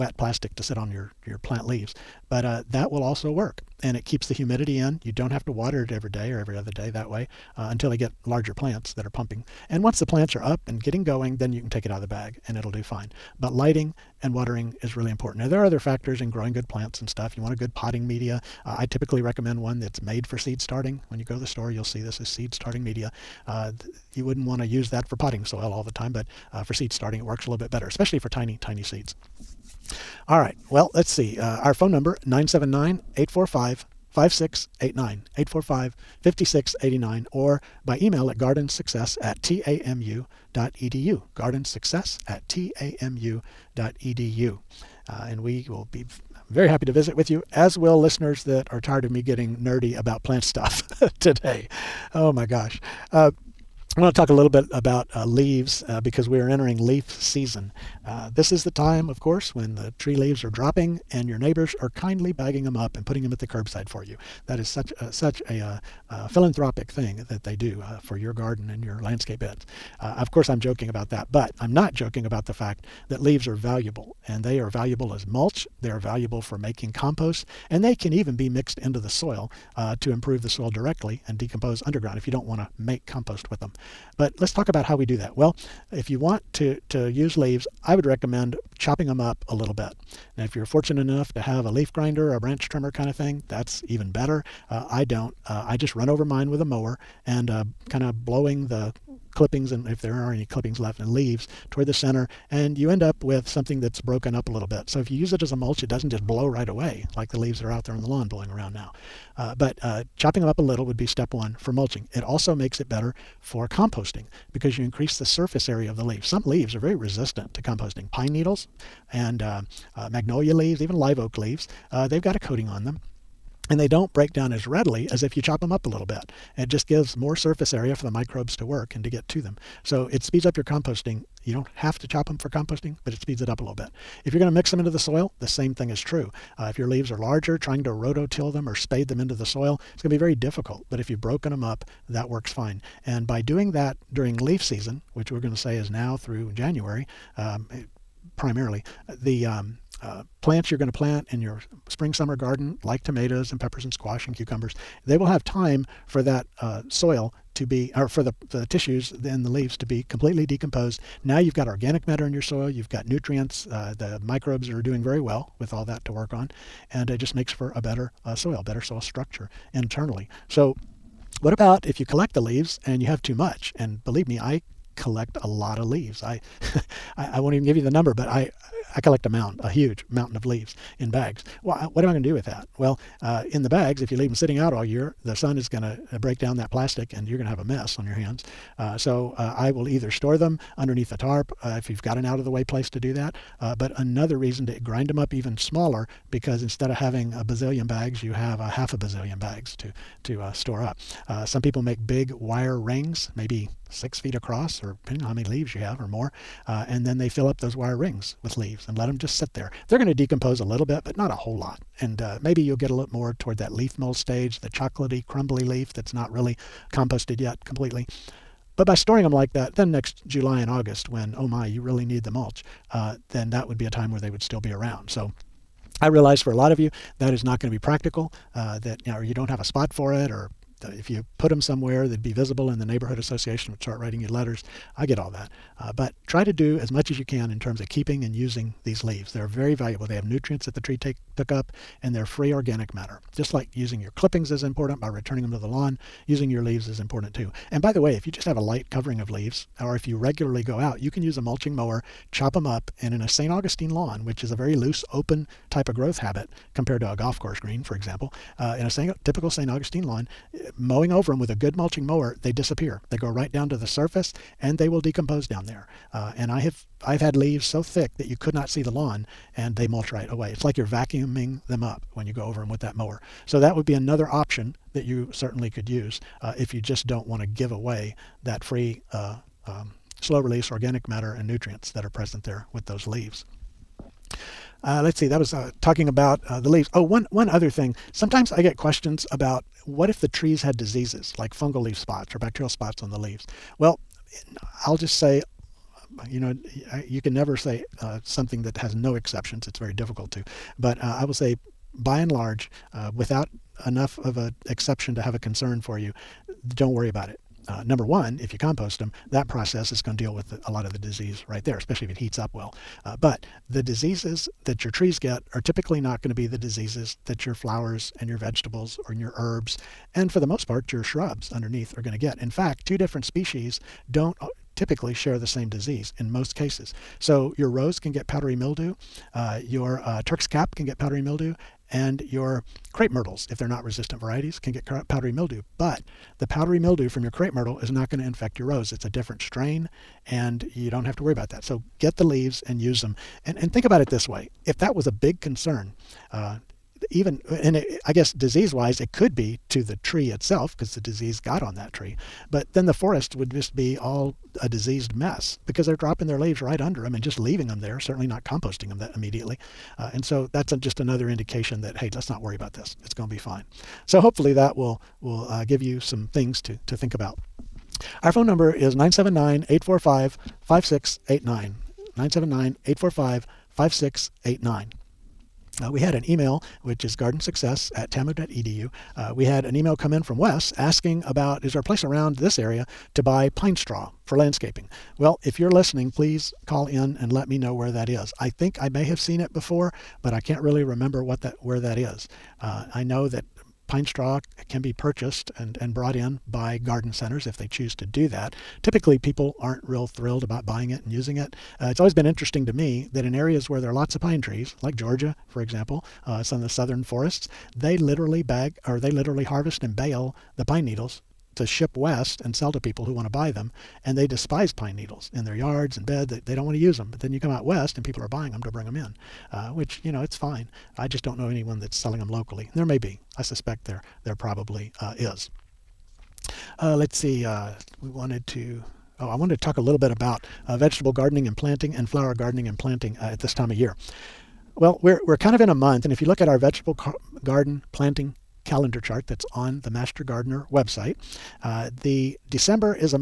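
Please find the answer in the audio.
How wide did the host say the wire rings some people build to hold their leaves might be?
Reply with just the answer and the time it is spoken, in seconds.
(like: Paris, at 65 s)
6 feet, at 203 s.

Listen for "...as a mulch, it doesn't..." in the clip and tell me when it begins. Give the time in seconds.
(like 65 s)
105 s.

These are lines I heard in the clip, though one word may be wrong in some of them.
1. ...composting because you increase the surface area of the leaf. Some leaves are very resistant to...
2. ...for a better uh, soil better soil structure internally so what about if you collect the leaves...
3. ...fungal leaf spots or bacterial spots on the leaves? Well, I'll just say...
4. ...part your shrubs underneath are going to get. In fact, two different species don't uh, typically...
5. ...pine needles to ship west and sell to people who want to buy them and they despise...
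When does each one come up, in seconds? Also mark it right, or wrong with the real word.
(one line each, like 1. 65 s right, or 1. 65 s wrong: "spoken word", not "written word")
1. 113 s right
2. 167 s right
3. 291 s right
4. 320 s right
5. 410 s right.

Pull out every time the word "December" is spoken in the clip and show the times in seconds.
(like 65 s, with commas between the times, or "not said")
442 s.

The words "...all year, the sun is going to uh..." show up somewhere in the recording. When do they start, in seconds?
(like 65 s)
184 s.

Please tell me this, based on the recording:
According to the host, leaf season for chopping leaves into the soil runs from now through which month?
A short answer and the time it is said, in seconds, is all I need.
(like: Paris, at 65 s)
January, at 146 s.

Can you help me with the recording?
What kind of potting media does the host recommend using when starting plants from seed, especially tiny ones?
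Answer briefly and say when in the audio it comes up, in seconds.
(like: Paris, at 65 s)
seed starting media, at 22 s.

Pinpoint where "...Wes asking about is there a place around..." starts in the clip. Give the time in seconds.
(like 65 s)
380 s.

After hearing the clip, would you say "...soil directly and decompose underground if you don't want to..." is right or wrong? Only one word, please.
right.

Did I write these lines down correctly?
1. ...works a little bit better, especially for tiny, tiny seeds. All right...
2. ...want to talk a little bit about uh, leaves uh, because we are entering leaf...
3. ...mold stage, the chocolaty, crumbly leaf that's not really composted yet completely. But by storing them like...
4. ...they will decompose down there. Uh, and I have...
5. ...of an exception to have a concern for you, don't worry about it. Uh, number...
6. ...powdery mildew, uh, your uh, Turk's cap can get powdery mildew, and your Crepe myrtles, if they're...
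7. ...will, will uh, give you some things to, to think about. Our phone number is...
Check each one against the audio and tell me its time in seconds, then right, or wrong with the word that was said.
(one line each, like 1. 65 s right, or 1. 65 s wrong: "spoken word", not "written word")
1. 27 s right
2. 54 s right
3. 213 s right
4. 264 s right
5. 304 s right
6. 328 s right
7. 364 s right.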